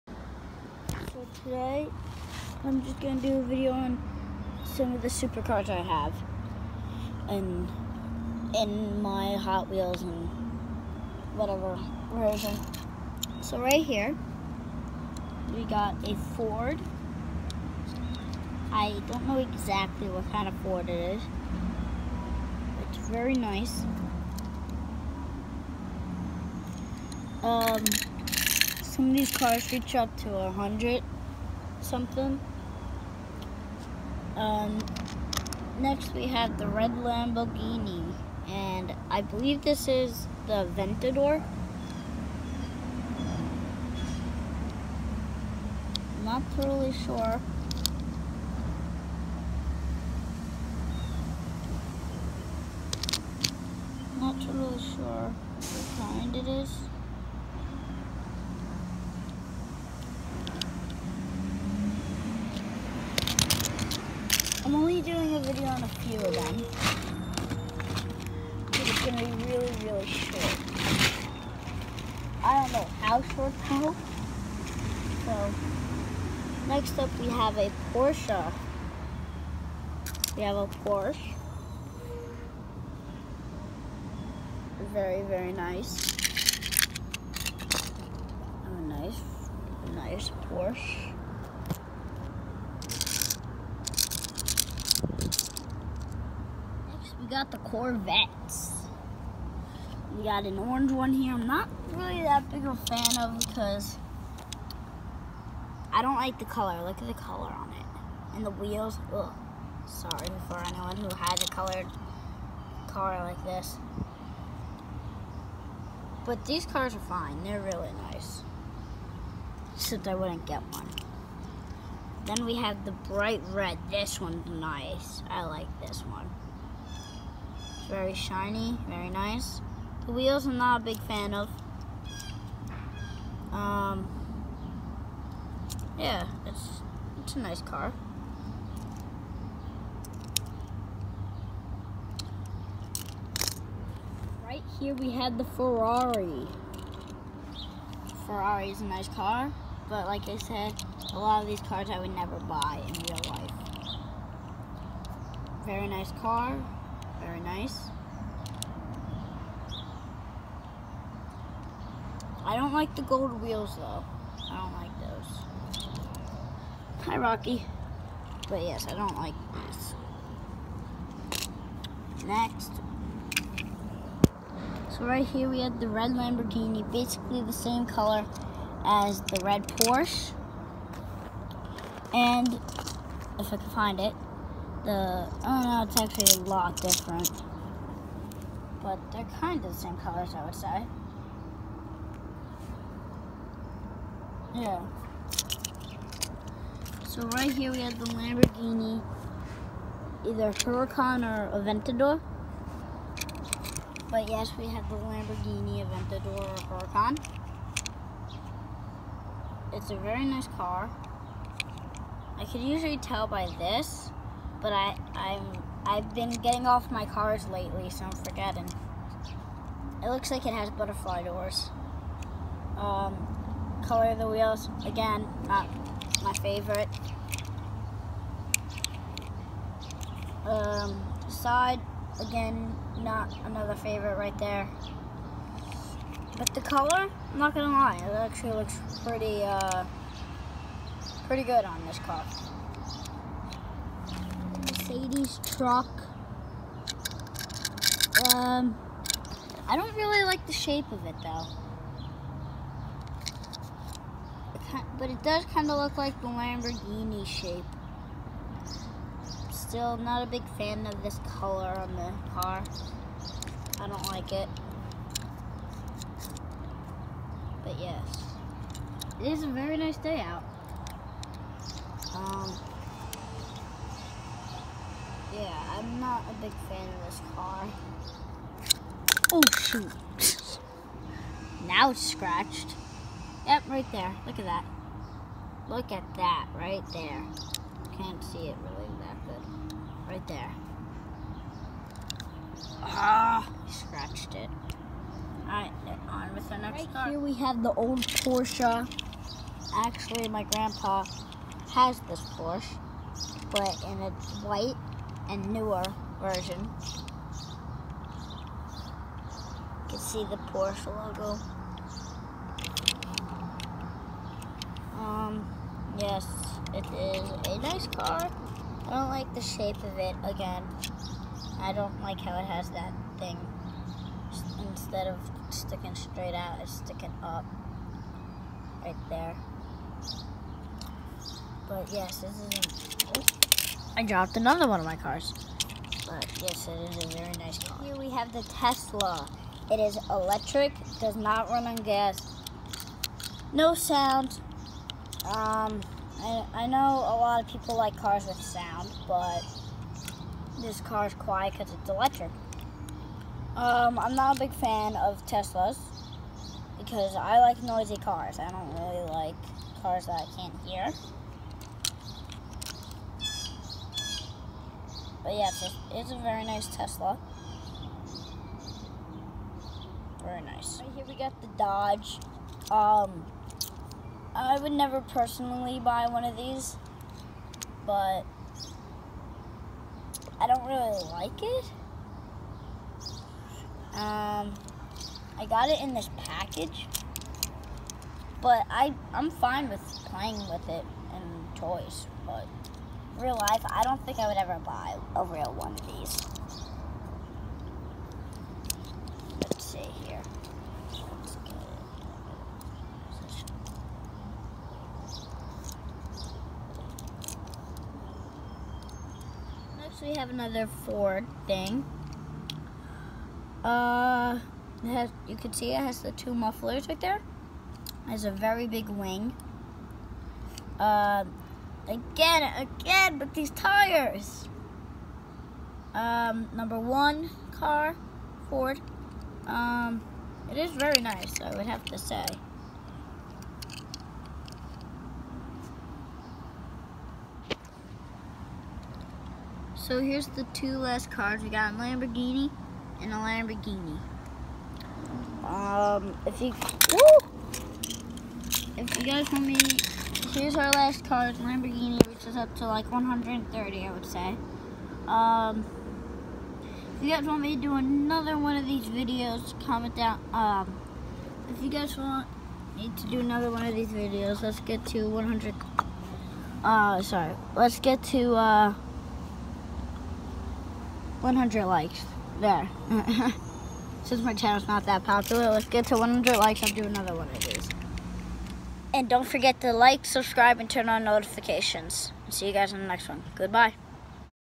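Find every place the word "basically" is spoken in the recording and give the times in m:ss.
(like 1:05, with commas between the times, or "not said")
2:56.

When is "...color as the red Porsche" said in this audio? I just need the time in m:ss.
2:57.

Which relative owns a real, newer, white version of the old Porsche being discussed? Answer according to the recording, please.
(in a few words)
Grandpa.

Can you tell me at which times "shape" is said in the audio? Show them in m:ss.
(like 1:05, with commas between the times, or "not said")
4:10, 4:17, 5:19.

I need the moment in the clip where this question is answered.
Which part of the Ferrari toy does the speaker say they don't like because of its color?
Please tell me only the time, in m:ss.
2:43.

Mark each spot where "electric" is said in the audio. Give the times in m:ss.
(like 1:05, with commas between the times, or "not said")
5:40, 5:51.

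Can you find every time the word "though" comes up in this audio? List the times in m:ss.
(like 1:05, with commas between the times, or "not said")
2:43, 4:11.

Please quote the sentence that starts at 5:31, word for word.
But yes, this is I dropped another one of my cars.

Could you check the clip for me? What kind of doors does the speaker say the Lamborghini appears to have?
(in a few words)
Butterfly doors.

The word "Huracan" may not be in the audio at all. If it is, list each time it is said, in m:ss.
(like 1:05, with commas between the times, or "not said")
3:20, 3:26.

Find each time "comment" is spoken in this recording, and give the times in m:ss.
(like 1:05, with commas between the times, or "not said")
7:39.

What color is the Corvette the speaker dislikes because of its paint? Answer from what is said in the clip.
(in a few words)
Orange.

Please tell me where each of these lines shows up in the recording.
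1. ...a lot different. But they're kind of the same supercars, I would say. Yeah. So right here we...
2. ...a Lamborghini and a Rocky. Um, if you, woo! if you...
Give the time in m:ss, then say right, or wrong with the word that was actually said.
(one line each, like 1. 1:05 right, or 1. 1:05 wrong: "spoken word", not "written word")
1. 3:06 wrong: "colors", not "supercars"
2. 7:21 wrong: "Lamborghini", not "Rocky".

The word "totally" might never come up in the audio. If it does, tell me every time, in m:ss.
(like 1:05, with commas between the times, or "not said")
0:46, 0:54.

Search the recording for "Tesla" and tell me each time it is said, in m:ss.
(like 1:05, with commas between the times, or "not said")
5:38, 5:55, 6:06.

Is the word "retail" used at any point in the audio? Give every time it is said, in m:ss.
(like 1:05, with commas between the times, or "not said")
not said.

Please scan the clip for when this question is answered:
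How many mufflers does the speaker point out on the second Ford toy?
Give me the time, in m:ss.
6:56.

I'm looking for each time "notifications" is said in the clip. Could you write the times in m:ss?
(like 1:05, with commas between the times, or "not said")
8:01.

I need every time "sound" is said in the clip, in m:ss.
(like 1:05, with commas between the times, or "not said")
5:43, 5:48.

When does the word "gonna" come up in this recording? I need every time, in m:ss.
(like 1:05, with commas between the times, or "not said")
1:09, 3:57.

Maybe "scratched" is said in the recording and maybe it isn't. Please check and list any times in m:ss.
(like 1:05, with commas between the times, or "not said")
4:42, 4:53.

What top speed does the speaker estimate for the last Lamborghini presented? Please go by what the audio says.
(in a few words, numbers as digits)
130.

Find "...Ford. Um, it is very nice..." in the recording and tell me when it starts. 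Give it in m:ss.
7:08.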